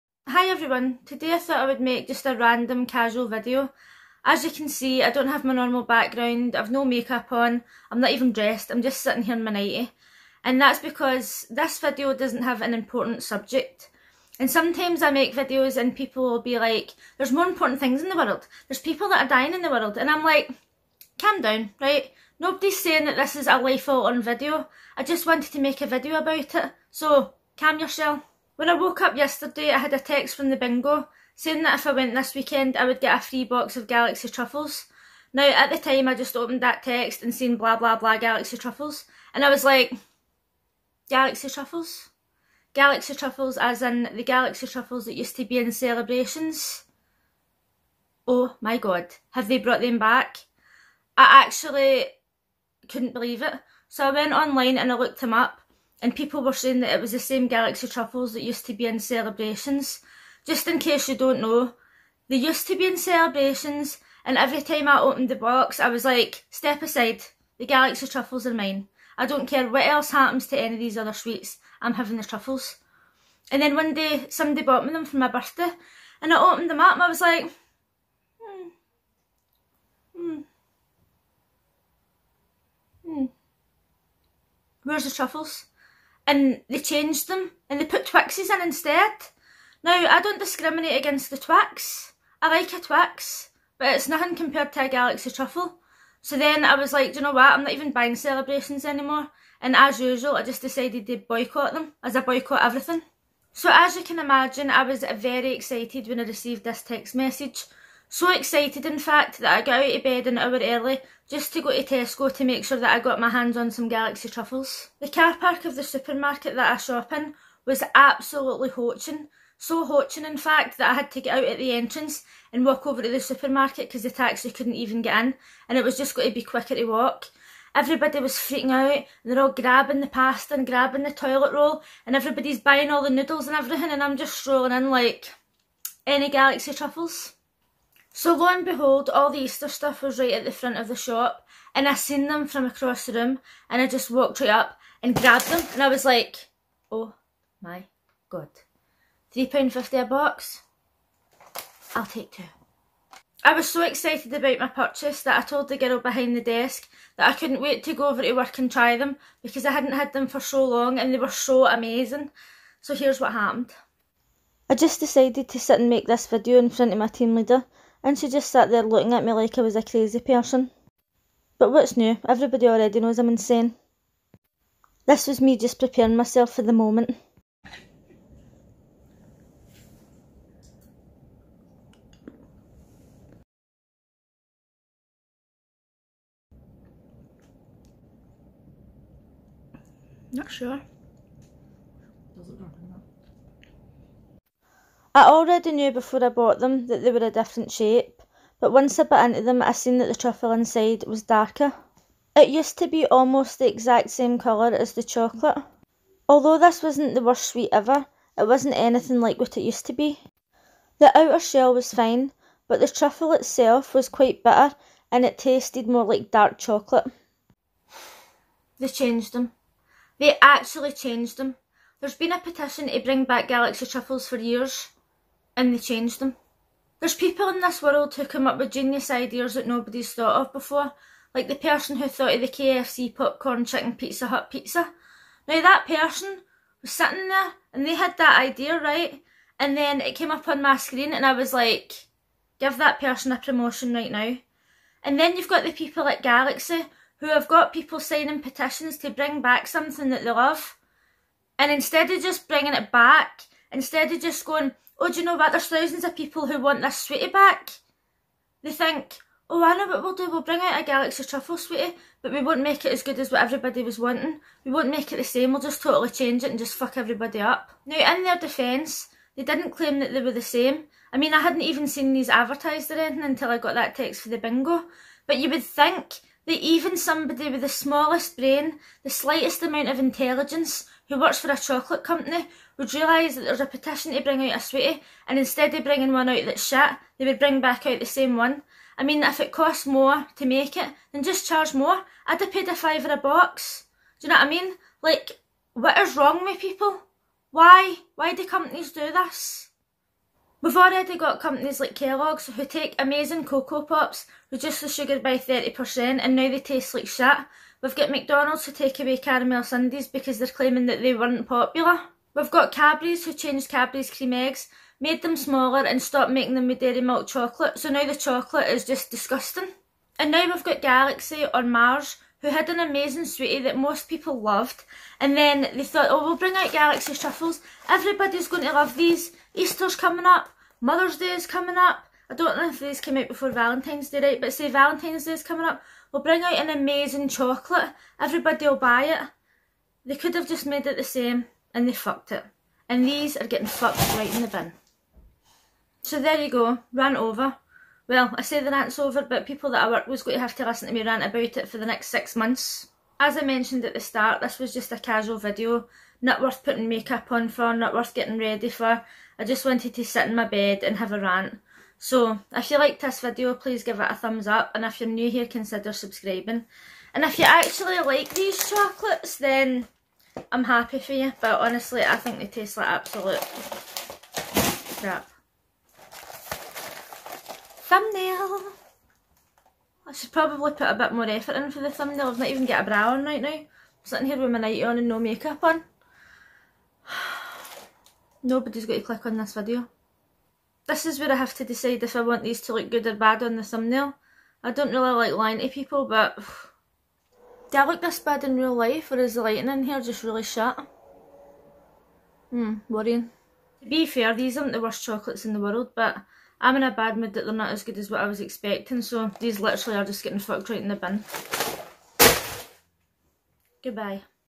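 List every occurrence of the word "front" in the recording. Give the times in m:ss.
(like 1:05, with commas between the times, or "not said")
2:20, 2:46.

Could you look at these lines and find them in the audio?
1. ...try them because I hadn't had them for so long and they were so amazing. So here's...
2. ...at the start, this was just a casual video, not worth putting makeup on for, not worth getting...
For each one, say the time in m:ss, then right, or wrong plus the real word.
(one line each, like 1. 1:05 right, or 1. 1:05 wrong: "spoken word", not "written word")
1. 2:38 right
2. 5:53 right.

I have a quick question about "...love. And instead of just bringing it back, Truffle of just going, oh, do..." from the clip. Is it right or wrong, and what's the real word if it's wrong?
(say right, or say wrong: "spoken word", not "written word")
wrong: "Instead", not "Truffle".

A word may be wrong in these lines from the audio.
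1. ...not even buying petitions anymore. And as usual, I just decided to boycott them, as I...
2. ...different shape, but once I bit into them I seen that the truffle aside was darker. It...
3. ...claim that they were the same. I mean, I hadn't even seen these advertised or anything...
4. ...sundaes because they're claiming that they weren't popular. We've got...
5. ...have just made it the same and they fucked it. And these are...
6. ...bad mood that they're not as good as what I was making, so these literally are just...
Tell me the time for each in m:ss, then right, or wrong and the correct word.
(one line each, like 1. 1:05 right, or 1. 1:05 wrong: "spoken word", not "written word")
1. 1:37 wrong: "celebrations", not "petitions"
2. 3:17 wrong: "inside", not "aside"
3. 4:29 right
4. 5:09 right
5. 5:40 right
6. 6:46 wrong: "expecting", not "making".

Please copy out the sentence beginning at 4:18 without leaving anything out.
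They think, oh, I know what we'll do.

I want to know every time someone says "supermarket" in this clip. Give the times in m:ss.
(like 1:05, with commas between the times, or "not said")
1:55, 2:03.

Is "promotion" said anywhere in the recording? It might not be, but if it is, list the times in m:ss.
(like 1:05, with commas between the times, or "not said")
4:03.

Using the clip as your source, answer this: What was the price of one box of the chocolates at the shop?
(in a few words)
£3.50.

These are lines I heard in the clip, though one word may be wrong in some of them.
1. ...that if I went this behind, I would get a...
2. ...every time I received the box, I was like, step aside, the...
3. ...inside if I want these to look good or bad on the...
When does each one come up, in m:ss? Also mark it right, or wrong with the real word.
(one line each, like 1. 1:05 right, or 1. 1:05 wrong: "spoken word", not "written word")
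1. 0:31 wrong: "weekend", not "behind"
2. 1:04 wrong: "opened", not "received"
3. 6:31 wrong: "decide", not "inside".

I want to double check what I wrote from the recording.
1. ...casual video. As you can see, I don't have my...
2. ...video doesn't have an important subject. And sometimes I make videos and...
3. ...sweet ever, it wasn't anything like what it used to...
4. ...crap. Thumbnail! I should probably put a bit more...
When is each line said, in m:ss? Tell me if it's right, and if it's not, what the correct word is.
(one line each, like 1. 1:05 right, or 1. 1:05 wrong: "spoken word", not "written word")
1. 0:02 right
2. 0:11 right
3. 3:27 right
4. 6:15 right.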